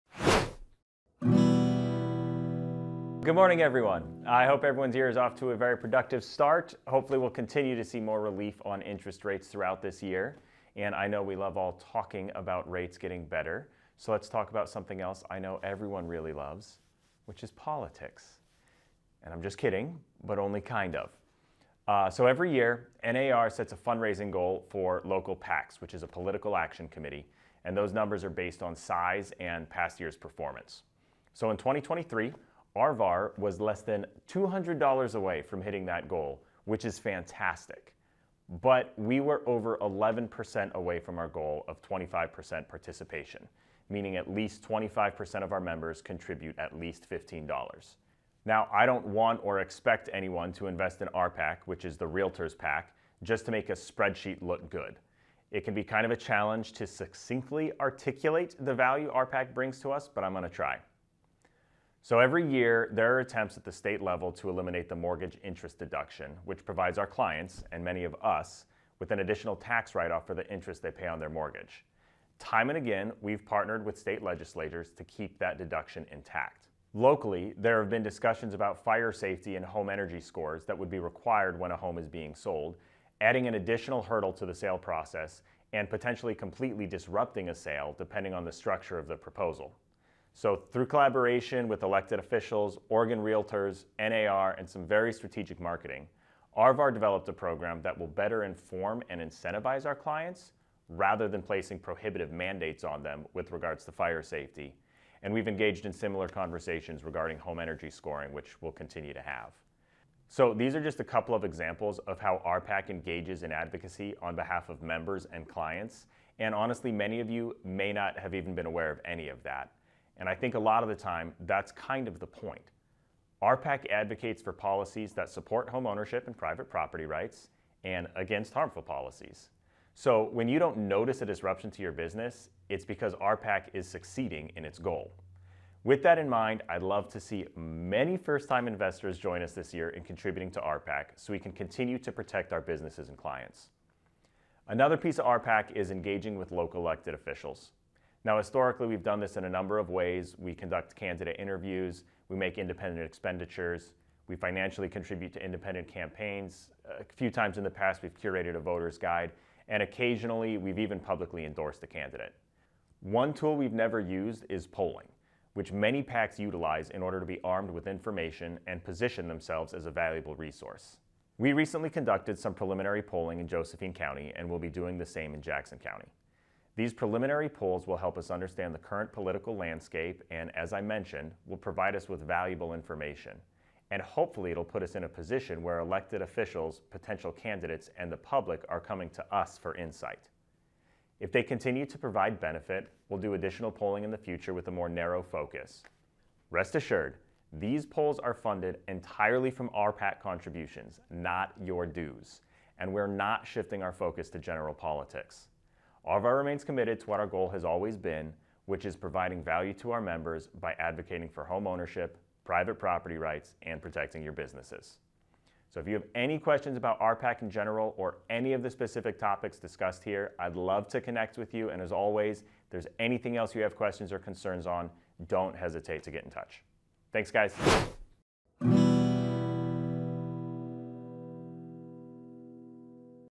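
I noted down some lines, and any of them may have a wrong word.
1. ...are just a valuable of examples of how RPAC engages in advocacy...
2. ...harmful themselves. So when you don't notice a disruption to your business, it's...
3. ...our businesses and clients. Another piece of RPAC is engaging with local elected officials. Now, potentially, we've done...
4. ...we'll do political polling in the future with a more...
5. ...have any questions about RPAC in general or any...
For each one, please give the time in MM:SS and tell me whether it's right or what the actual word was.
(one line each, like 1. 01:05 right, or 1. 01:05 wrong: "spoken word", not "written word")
1. 01:50 wrong: "couple", not "valuable"
2. 02:08 wrong: "policies", not "themselves"
3. 02:22 wrong: "historically", not "potentially"
4. 03:13 wrong: "additional", not "political"
5. 03:35 right.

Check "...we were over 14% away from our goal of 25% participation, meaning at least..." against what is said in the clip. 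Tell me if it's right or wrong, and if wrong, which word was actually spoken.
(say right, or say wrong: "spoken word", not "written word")
wrong: "11", not "14".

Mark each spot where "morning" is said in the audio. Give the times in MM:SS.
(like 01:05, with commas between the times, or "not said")
00:03.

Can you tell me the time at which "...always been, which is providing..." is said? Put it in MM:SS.
03:27.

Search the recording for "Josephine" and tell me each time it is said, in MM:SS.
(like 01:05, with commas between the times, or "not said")
02:53.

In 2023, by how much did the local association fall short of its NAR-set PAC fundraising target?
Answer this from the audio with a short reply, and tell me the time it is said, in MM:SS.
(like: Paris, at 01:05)
Less than $200, at 00:33.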